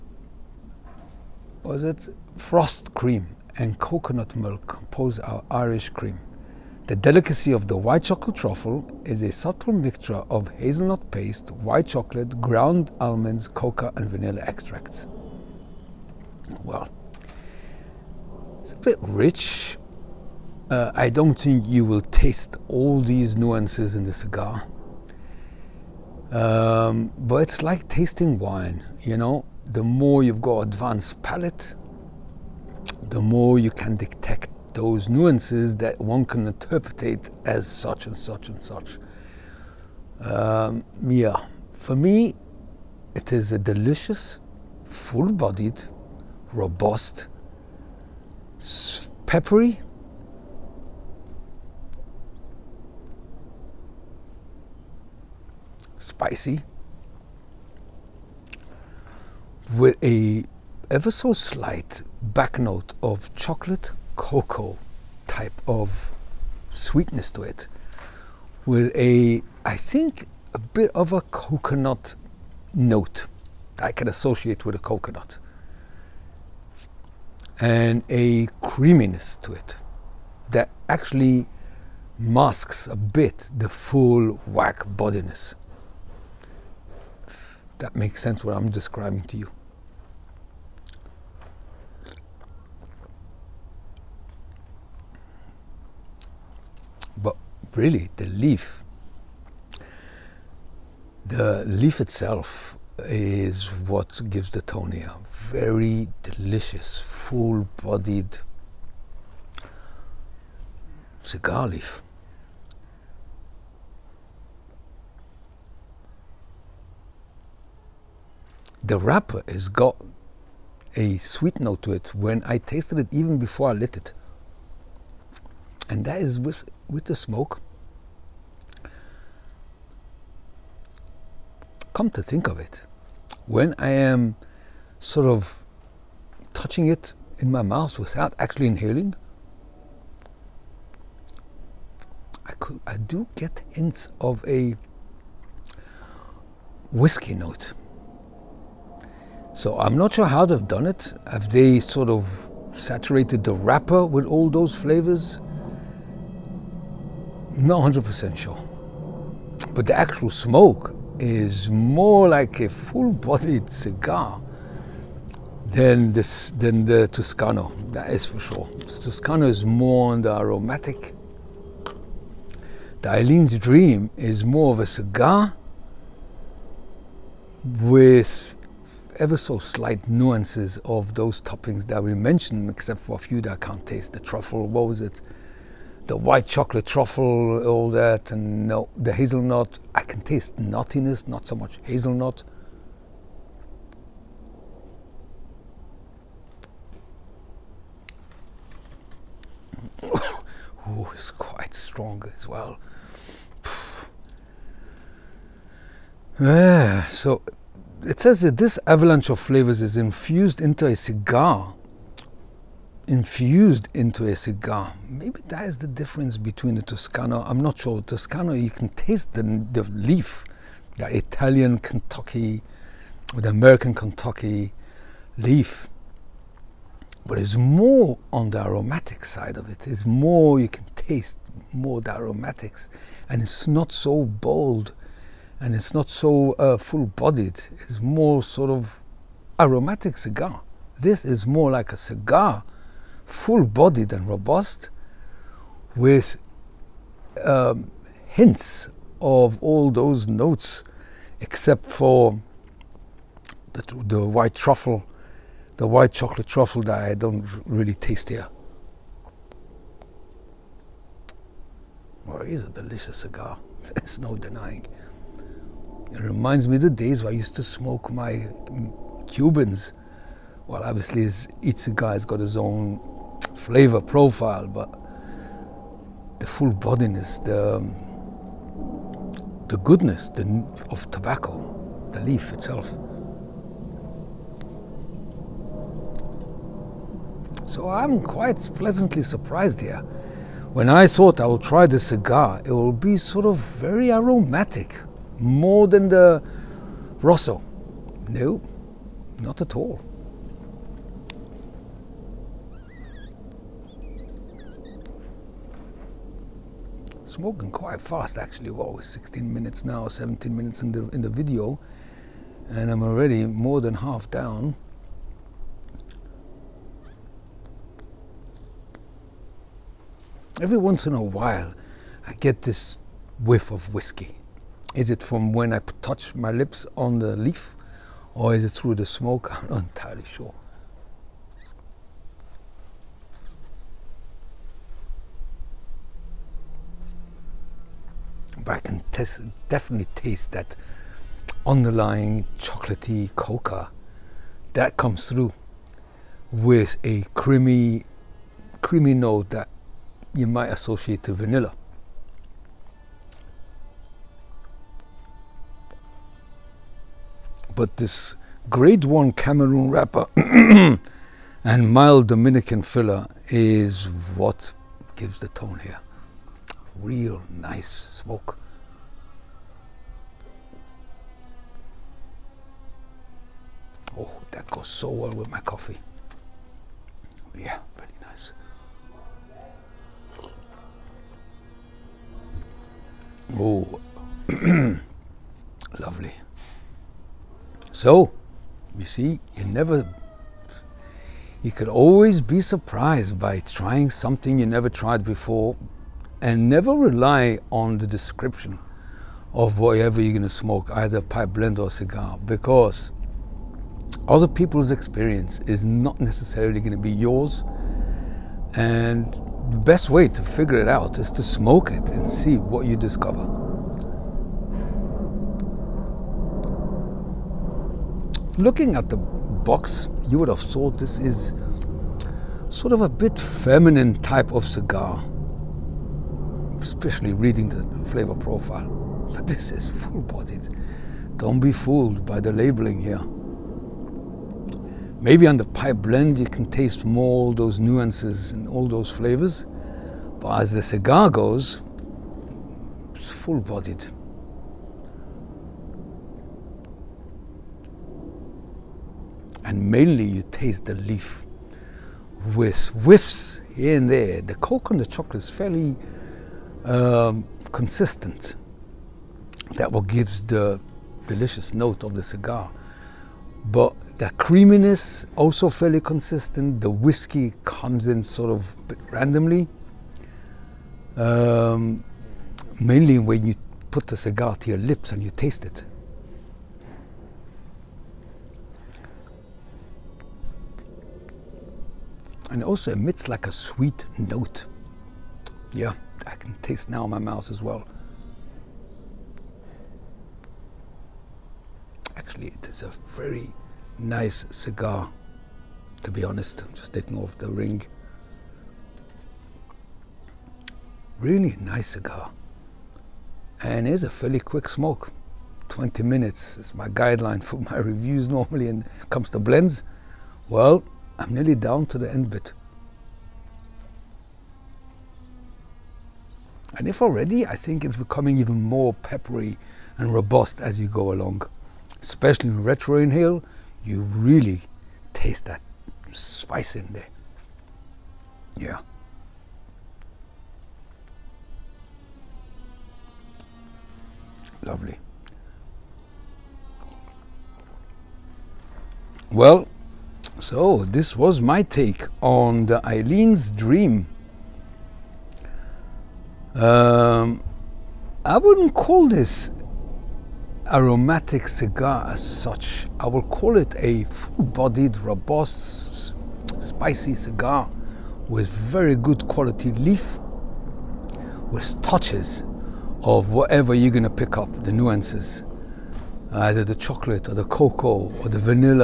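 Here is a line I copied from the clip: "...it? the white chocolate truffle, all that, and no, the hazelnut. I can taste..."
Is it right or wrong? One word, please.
right.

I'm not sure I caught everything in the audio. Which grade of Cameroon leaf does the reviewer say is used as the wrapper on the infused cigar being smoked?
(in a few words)
grade one.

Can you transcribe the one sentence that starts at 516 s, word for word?
And if already, I think it's becoming even more peppery and robust as you go along.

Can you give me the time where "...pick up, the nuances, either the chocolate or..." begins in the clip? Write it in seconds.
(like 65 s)
564 s.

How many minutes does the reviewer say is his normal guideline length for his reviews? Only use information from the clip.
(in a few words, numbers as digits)
20.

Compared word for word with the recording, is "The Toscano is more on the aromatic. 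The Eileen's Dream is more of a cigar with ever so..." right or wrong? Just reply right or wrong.
right.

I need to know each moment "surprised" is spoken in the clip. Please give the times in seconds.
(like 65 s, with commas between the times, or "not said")
289 s, 392 s.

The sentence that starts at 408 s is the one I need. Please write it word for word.
And the best way to figure it out is to smoke it and see what you discover.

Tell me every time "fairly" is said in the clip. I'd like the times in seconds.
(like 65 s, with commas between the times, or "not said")
455 s, 465 s, 504 s.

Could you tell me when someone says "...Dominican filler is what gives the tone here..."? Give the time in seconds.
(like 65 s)
362 s.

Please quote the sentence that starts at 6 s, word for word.
The delicacy of the white chocolate truffle is a subtle mixture of hazelnut paste, white chocolate, ground almonds, coca, and vanilla extracts.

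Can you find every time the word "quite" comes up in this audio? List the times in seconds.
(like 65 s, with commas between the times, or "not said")
201 s, 288 s, 307 s.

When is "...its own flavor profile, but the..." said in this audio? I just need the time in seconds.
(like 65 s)
272 s.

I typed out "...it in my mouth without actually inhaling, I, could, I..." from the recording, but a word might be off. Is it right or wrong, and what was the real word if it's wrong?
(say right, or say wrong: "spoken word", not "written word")
right.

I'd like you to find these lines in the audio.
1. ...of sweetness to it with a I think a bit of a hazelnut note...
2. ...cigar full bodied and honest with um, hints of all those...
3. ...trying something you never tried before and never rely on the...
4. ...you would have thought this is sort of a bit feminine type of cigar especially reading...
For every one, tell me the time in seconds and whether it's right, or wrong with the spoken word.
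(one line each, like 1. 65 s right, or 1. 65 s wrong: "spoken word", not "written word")
1. 65 s wrong: "coconut", not "hazelnut"
2. 241 s wrong: "robust", not "honest"
3. 393 s right
4. 420 s right.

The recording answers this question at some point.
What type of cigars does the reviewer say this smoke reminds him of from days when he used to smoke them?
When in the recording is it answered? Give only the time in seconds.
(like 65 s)
269 s.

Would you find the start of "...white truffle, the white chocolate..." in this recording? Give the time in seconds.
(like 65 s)
254 s.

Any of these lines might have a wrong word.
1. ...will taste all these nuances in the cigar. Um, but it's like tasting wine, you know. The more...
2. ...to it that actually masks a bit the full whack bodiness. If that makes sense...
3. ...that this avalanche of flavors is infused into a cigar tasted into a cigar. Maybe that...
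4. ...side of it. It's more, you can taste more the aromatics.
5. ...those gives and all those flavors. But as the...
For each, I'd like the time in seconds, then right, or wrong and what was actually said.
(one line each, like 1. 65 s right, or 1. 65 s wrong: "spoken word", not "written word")
1. 21 s right
2. 79 s right
3. 208 s wrong: "infused", not "tasted"
4. 229 s right
5. 437 s wrong: "nuances", not "gives".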